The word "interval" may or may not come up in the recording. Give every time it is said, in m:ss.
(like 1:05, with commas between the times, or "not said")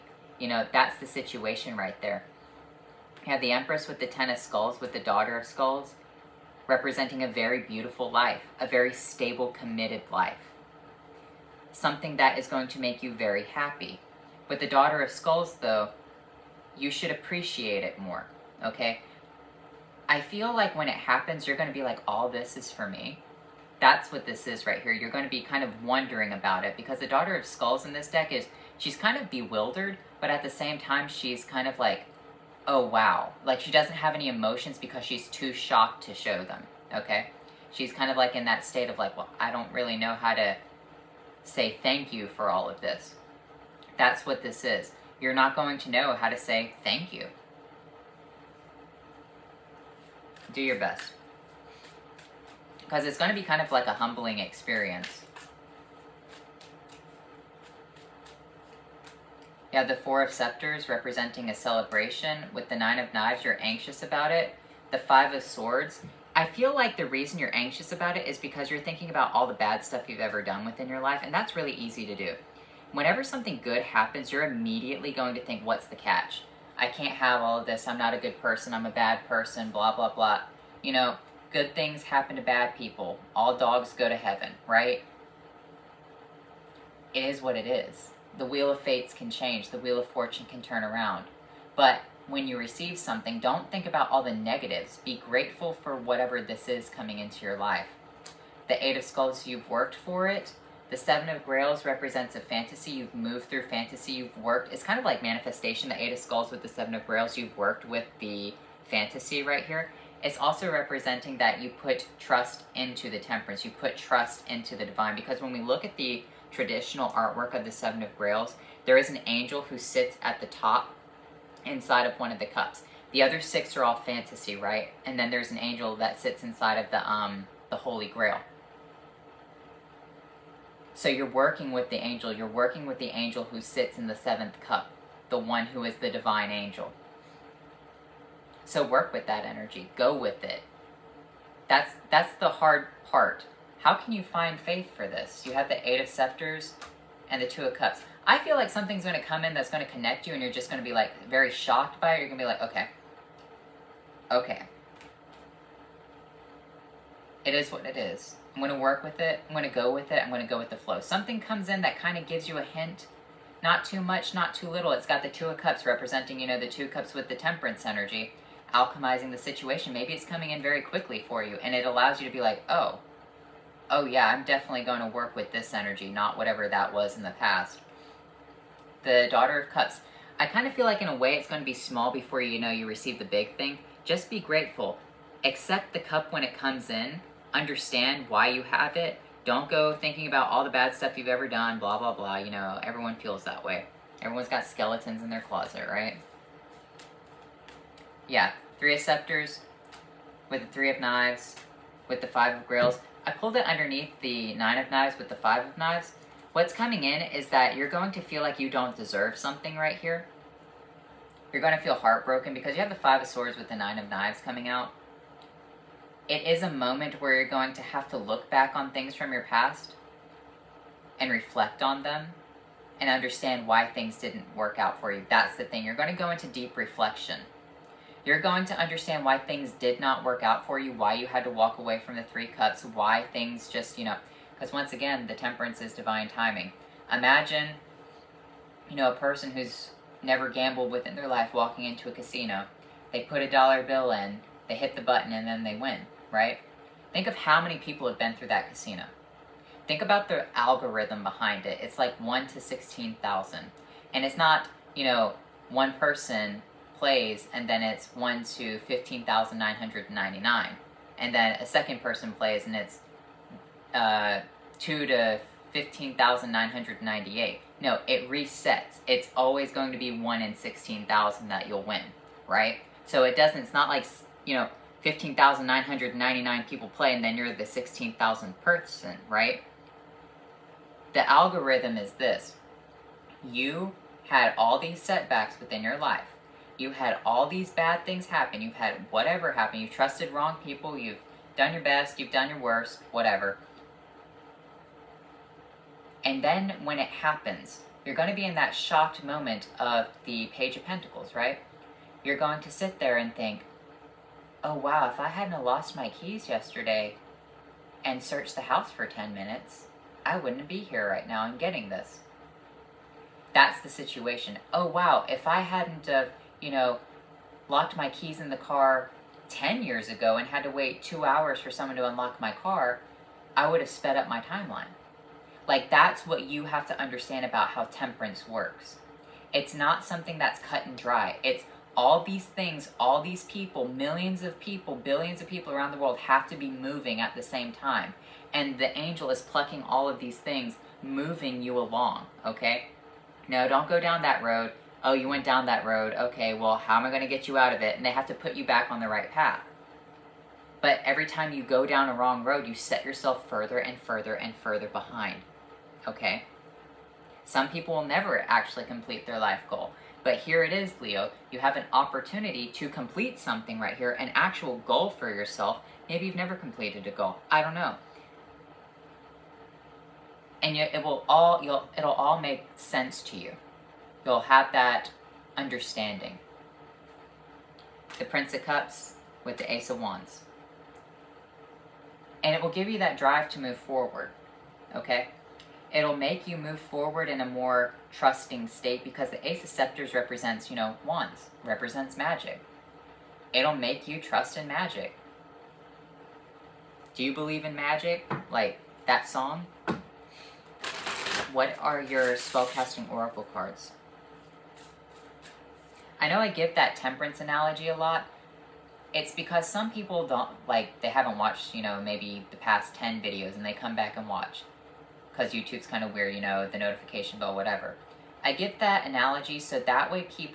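not said.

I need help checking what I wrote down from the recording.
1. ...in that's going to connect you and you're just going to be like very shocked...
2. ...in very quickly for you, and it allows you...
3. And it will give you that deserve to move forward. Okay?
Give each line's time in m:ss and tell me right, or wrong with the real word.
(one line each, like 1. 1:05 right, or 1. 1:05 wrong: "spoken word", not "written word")
1. 2:29 right
2. 2:50 right
3. 6:22 wrong: "drive", not "deserve".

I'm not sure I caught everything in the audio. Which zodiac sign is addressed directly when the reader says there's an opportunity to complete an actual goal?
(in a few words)
Leo.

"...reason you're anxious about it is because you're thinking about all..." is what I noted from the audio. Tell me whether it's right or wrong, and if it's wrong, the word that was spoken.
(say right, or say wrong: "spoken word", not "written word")
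right.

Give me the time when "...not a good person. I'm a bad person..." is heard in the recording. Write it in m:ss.
1:17.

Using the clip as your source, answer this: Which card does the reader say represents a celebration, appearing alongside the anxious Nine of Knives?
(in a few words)
Four of Scepters.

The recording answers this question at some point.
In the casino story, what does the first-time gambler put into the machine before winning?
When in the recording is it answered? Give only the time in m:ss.
4:03.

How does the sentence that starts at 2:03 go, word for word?
The other six are all fantasy, right?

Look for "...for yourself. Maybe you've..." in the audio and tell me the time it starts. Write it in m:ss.
6:05.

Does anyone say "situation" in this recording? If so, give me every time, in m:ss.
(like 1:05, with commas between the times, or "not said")
0:01, 2:49, 5:13.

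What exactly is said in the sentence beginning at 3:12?
You know, everyone feels that way.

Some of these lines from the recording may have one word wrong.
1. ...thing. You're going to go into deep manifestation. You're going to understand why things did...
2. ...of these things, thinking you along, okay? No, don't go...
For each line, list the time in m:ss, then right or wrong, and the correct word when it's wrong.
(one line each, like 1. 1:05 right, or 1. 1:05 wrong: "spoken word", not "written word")
1. 3:45 wrong: "reflection", not "manifestation"
2. 5:40 wrong: "moving", not "thinking".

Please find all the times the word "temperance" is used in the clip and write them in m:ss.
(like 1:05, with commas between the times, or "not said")
1:53, 2:47, 3:55, 5:27, 6:46.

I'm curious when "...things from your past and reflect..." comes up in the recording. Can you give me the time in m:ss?
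3:38.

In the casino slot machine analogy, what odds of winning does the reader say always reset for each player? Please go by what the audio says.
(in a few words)
1 in 16,000.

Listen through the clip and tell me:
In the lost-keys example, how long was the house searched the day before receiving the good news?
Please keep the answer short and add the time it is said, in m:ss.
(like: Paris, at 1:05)
10 minutes, at 5:09.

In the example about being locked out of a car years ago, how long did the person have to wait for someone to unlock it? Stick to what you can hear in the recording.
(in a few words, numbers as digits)
2 hours.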